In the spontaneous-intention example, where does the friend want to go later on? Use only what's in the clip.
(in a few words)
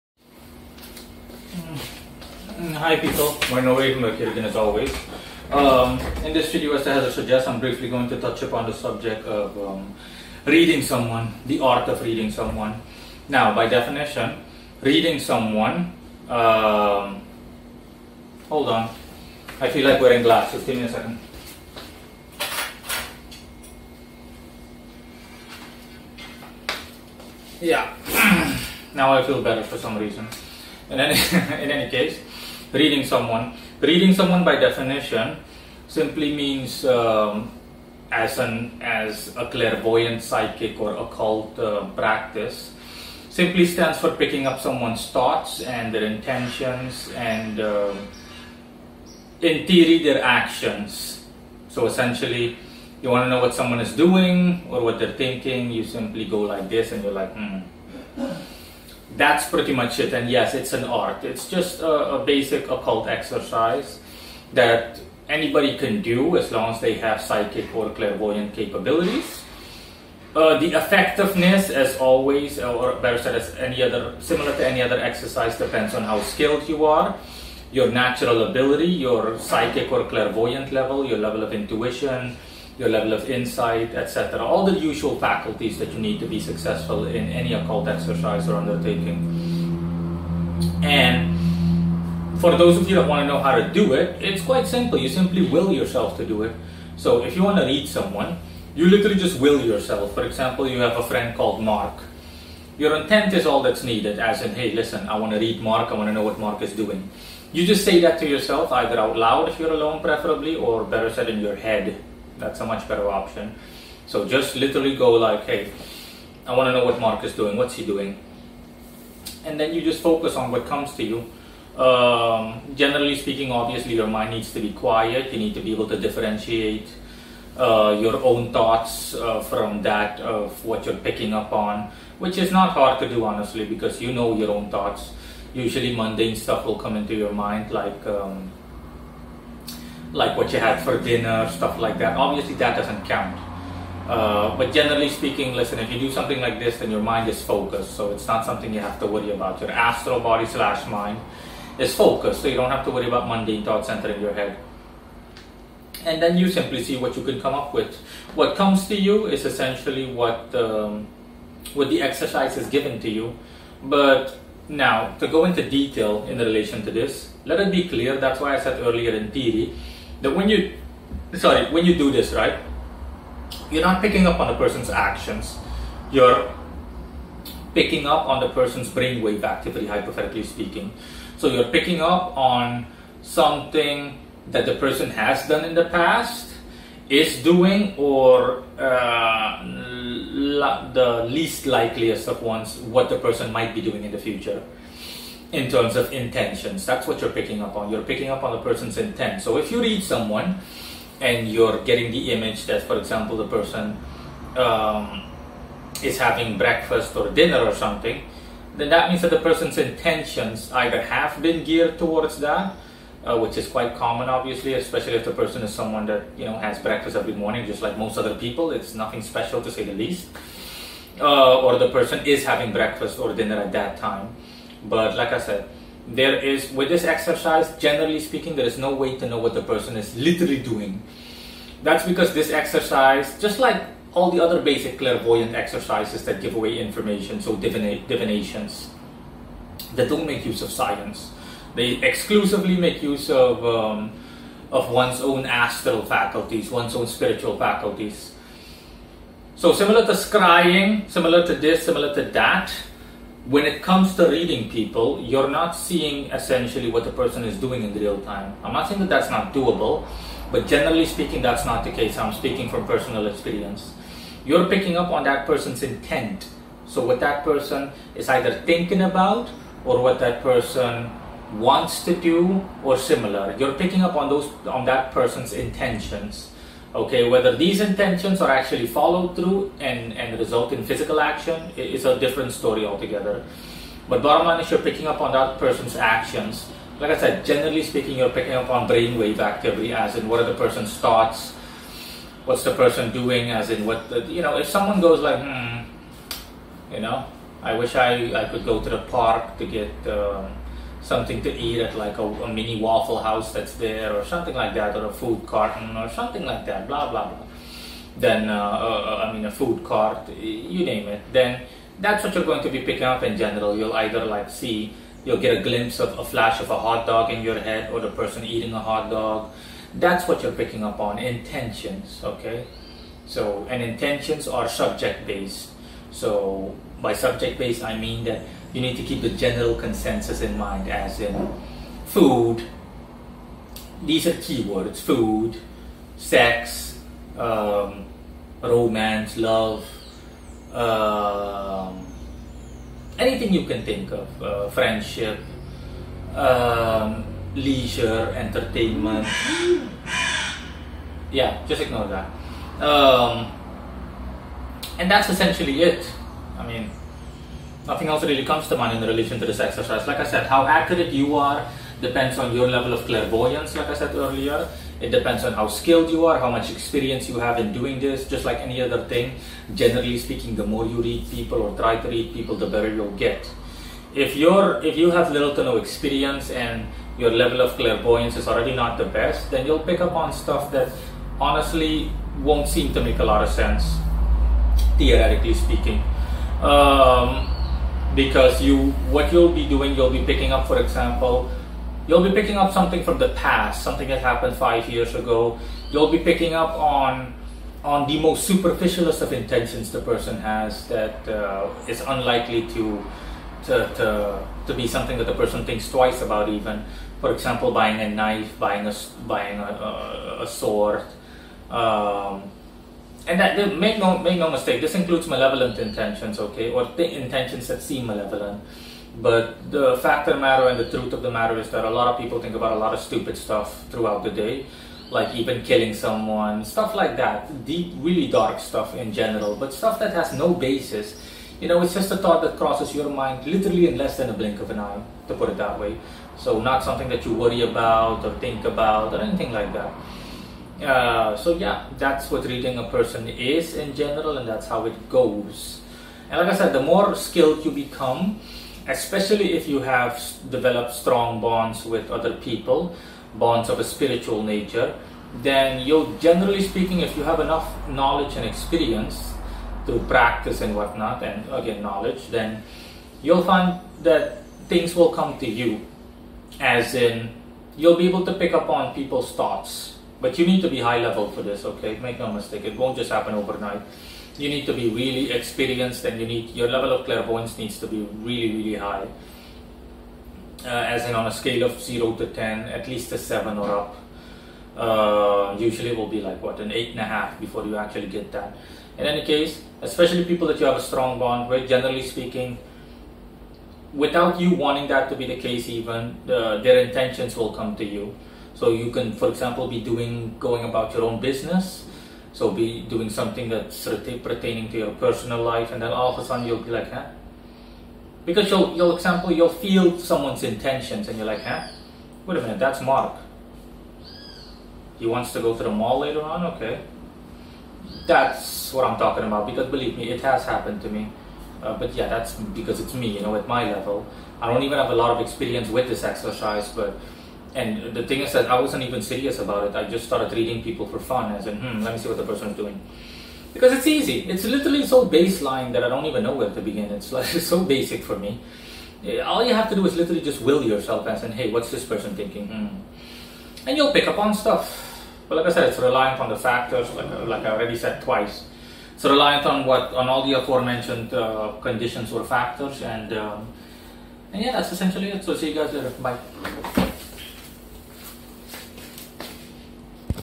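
the mall.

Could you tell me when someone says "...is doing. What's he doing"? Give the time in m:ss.
1:57.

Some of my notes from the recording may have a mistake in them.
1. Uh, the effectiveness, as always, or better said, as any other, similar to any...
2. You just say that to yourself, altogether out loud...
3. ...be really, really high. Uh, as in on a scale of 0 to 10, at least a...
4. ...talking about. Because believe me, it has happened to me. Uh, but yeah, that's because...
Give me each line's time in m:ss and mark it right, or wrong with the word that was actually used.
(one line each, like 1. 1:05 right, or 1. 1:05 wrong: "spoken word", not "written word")
1. 1:10 right
2. 1:47 wrong: "either", not "altogether"
3. 7:57 right
4. 8:38 right.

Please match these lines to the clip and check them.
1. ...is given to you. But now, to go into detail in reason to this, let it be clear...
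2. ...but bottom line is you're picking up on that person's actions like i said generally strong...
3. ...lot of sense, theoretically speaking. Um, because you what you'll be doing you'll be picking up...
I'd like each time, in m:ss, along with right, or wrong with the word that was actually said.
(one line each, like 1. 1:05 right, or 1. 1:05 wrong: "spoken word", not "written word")
1. 2:42 wrong: "relation", not "reason"
2. 4:44 wrong: "speaking", not "strong"
3. 6:23 right.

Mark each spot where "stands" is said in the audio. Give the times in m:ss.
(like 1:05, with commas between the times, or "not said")
0:43.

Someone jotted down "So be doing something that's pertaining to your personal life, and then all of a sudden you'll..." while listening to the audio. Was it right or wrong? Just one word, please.
right.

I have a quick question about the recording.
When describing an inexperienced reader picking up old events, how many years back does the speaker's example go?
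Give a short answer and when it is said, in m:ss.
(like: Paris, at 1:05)
5, at 6:34.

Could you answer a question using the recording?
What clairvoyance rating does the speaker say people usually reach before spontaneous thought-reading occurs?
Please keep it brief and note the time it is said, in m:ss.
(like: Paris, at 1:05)
8.5, at 8:06.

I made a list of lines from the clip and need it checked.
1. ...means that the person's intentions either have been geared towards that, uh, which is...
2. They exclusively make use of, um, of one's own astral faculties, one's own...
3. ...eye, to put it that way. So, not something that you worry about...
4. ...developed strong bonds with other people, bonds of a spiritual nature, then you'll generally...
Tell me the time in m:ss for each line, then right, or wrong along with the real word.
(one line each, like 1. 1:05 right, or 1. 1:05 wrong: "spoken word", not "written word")
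1. 3:29 right
2. 4:01 right
3. 7:14 right
4. 7:30 right.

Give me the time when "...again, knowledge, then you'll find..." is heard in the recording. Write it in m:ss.
7:41.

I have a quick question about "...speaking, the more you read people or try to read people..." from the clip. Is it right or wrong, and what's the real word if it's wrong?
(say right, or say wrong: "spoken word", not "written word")
right.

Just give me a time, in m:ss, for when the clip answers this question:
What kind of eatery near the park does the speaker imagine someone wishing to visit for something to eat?
5:02.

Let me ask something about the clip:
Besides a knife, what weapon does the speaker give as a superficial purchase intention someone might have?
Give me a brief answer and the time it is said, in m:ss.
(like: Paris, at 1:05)
sword, at 6:50.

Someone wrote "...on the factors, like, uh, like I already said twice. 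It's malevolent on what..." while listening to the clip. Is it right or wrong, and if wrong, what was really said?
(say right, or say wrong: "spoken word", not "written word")
wrong: "reliant", not "malevolent".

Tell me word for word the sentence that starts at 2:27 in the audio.
So it's not something you have to worry about.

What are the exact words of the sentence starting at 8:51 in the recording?
I said, hmm, let me see what the person is doing.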